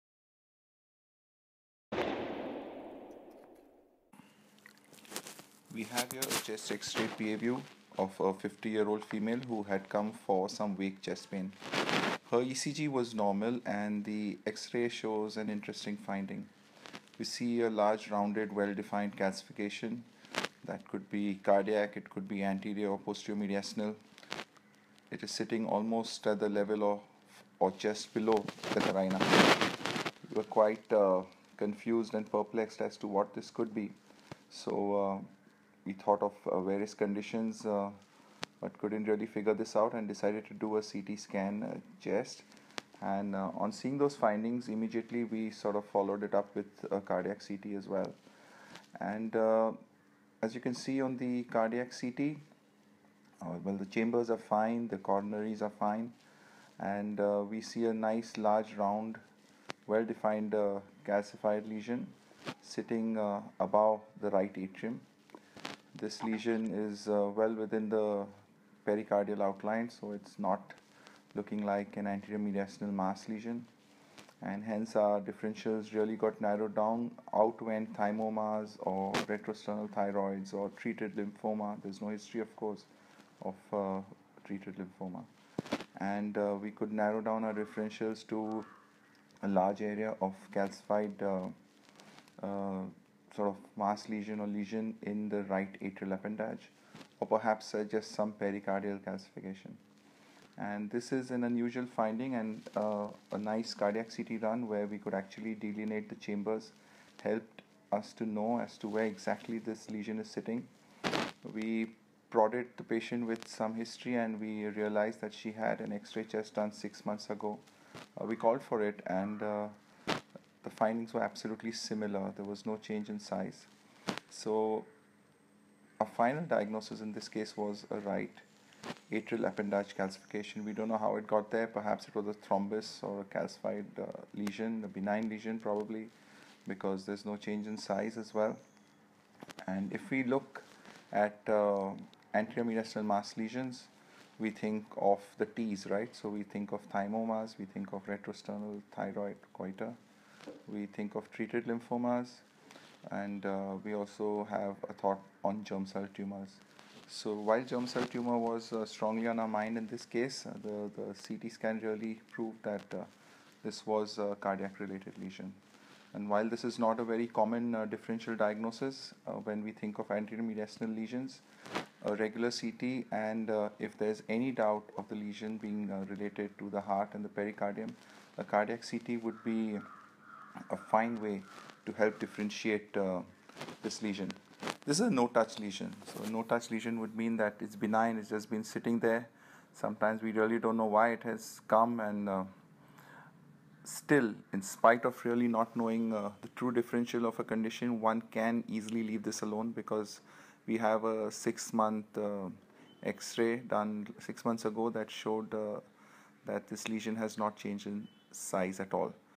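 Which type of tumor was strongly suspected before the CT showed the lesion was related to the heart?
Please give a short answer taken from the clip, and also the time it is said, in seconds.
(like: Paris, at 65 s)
Germ cell tumor, at 157 s.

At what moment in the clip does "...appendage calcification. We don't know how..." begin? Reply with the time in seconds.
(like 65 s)
129 s.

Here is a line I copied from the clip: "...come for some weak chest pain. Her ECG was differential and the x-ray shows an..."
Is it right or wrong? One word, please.
wrong.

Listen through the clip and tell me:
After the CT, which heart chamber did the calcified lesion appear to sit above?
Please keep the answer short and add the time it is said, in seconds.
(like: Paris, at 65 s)
Right atrium, at 64 s.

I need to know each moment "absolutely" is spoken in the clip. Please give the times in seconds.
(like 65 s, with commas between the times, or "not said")
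121 s.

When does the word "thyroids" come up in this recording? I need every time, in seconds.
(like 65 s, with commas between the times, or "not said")
79 s, 148 s.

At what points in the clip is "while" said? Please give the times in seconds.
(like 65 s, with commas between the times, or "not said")
157 s, 166 s.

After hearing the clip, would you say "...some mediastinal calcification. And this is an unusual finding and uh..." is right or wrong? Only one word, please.
wrong.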